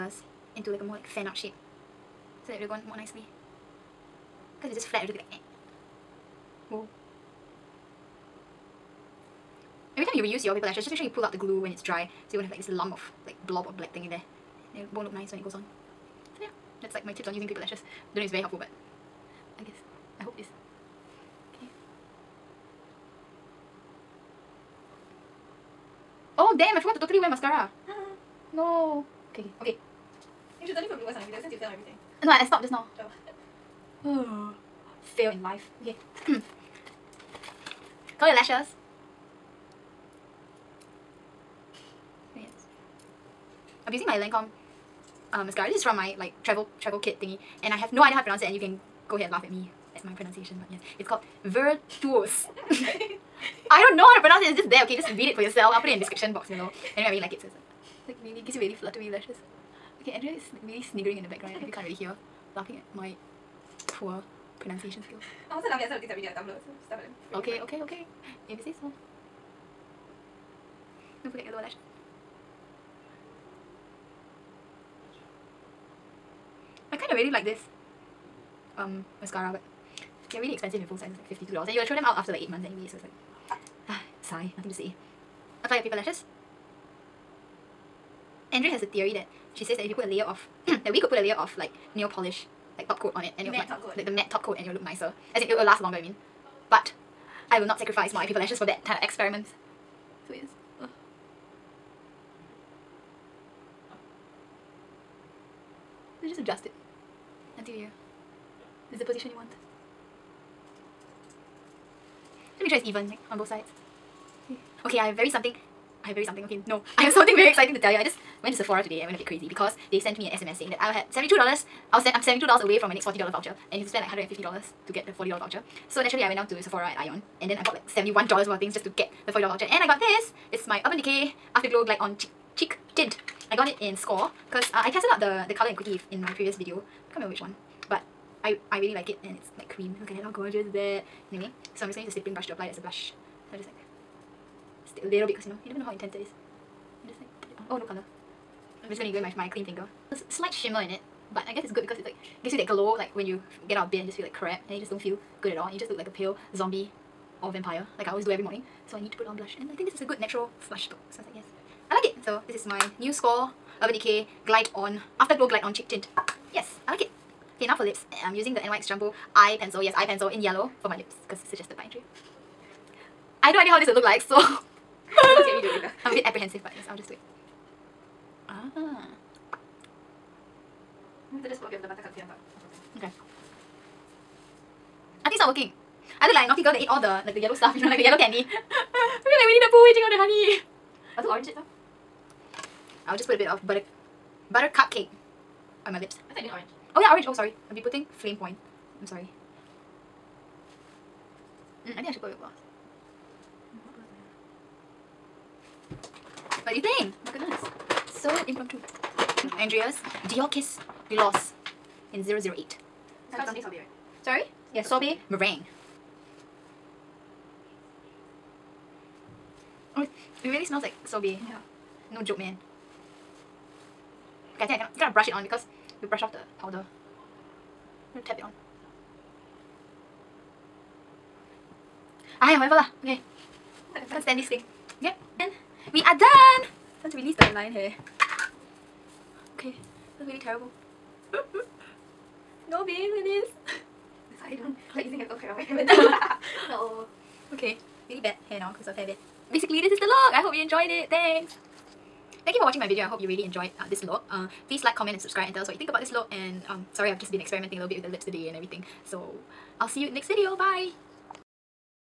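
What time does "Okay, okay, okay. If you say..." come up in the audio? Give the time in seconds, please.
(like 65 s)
67 s.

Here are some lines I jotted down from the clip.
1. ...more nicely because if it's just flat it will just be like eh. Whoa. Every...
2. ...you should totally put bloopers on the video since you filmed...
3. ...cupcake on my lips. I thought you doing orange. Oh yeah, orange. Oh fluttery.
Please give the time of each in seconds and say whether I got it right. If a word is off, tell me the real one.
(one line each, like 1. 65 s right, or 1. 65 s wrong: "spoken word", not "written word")
1. 2 s right
2. 30 s right
3. 194 s wrong: "sorry", not "fluttery".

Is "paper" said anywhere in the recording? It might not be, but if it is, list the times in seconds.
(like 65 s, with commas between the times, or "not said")
10 s, 17 s, 85 s, 98 s.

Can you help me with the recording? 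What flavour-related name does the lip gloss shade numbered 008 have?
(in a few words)
sorbet meringue.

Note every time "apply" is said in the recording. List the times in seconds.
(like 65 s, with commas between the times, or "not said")
85 s, 142 s.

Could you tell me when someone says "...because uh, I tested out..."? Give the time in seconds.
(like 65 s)
134 s.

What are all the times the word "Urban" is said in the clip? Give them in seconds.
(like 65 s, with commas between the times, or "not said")
130 s, 163 s.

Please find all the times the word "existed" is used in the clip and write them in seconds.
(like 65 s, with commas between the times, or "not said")
not said.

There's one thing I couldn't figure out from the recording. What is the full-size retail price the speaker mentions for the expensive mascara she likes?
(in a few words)
$52.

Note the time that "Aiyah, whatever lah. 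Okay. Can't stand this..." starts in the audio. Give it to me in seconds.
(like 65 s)
232 s.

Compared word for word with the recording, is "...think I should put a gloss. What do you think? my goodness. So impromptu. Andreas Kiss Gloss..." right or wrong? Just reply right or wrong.
right.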